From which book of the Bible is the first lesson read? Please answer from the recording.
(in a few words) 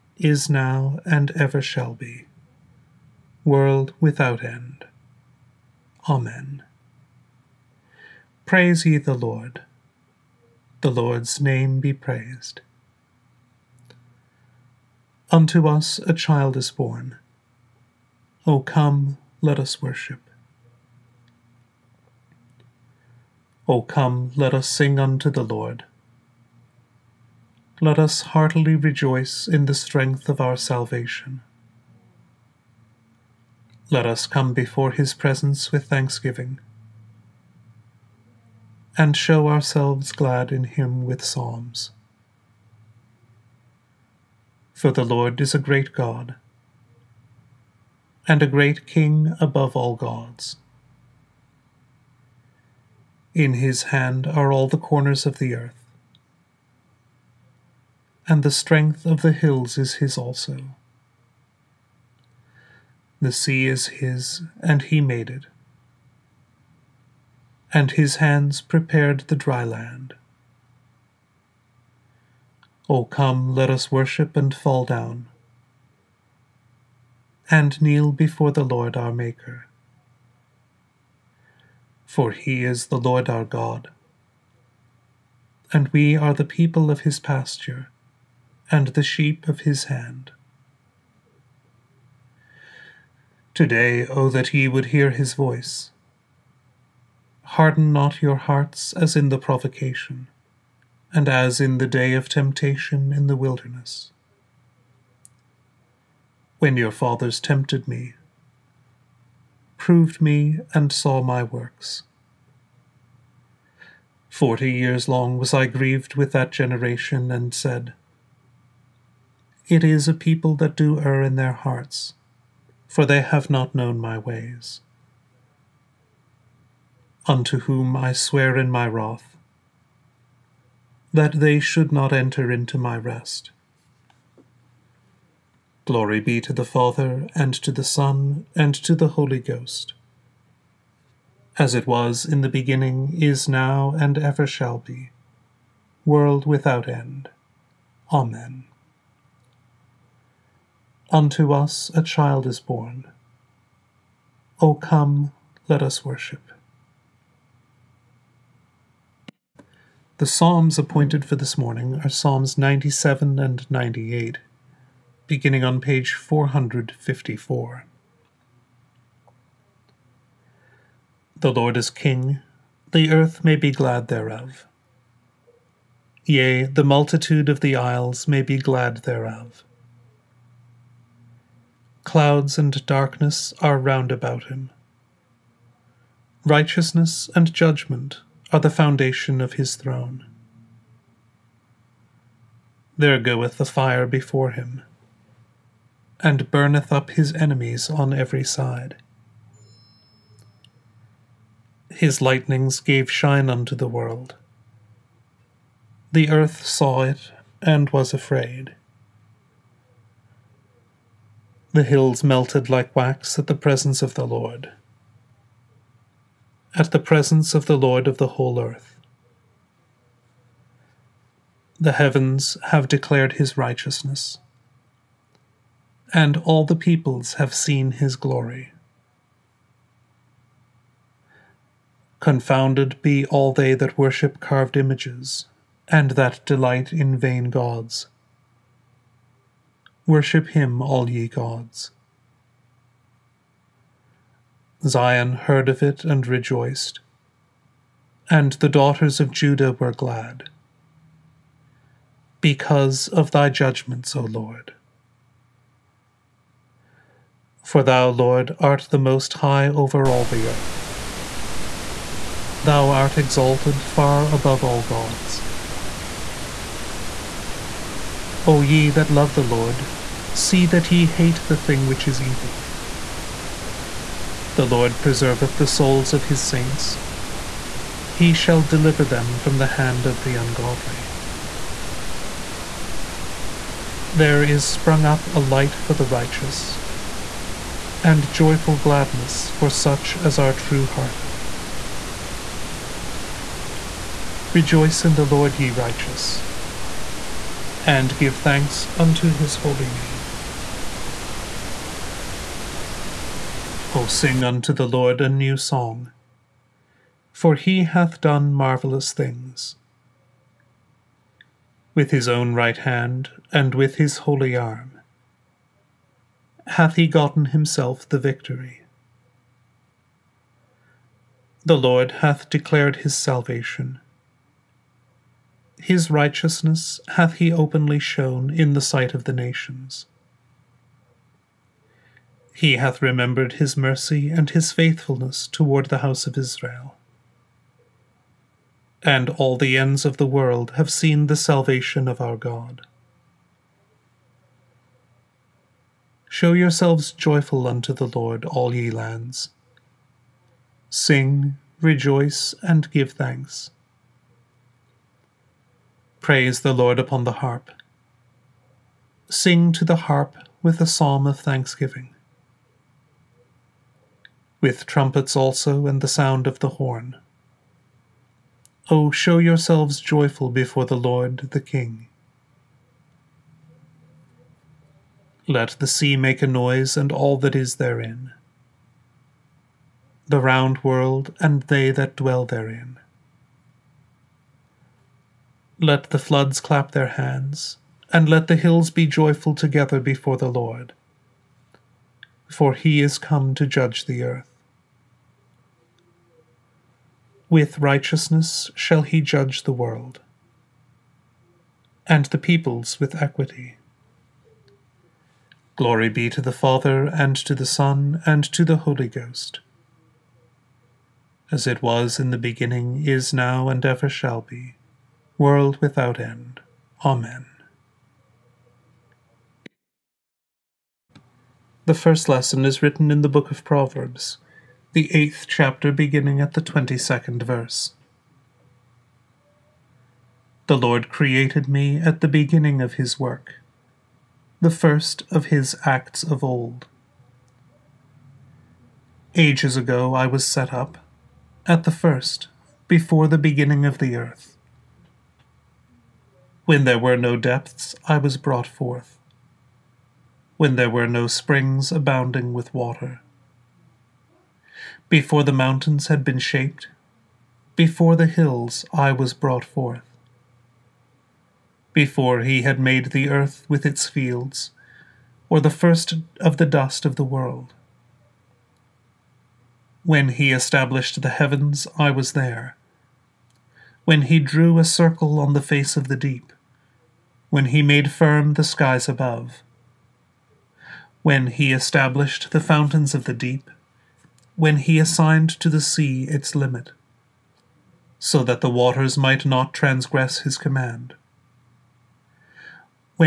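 Proverbs.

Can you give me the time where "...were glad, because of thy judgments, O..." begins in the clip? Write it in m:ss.
4:09.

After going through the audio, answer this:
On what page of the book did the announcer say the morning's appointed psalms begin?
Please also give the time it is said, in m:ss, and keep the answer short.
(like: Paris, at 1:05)
454, at 2:45.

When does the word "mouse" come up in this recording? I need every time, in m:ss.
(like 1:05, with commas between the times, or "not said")
not said.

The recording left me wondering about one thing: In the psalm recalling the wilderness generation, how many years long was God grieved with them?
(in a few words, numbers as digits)
40.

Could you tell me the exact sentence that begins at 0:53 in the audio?
In his hand are all the corners of the earth, and the strength of the hills is his also.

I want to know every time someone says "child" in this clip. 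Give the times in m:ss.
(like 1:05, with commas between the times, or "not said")
0:16, 2:32.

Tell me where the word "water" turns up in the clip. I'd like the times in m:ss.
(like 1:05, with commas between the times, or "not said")
7:32, 8:08.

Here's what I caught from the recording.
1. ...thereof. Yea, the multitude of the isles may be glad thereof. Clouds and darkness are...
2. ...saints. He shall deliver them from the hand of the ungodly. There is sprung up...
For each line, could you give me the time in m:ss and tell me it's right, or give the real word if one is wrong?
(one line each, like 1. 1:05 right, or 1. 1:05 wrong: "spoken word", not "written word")
1. 2:54 right
2. 4:36 right.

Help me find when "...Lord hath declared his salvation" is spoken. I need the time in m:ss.
5:21.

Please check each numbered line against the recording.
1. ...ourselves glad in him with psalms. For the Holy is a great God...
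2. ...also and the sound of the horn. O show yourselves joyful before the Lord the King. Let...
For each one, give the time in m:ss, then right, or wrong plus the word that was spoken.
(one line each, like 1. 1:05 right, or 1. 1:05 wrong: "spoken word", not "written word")
1. 0:39 wrong: "Lord", not "Holy"
2. 6:05 right.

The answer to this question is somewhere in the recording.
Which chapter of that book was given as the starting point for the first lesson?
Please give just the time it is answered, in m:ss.
7:05.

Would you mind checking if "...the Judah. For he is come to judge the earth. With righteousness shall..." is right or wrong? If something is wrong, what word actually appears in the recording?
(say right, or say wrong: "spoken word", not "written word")
wrong: "Lord", not "Judah".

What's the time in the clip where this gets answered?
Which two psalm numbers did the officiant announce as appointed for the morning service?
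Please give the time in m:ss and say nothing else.
2:42.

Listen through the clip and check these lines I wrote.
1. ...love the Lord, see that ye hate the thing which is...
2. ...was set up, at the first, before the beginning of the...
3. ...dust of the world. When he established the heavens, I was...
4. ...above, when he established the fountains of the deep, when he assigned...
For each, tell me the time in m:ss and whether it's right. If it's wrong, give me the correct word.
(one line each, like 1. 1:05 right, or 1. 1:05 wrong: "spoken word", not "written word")
1. 4:29 right
2. 7:20 right
3. 7:46 right
4. 7:59 right.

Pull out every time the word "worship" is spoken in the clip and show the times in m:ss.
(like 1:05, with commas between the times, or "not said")
0:19, 1:13, 2:36, 3:53, 4:00.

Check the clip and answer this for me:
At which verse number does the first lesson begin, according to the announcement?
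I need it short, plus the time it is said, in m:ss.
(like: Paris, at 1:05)
22, at 7:06.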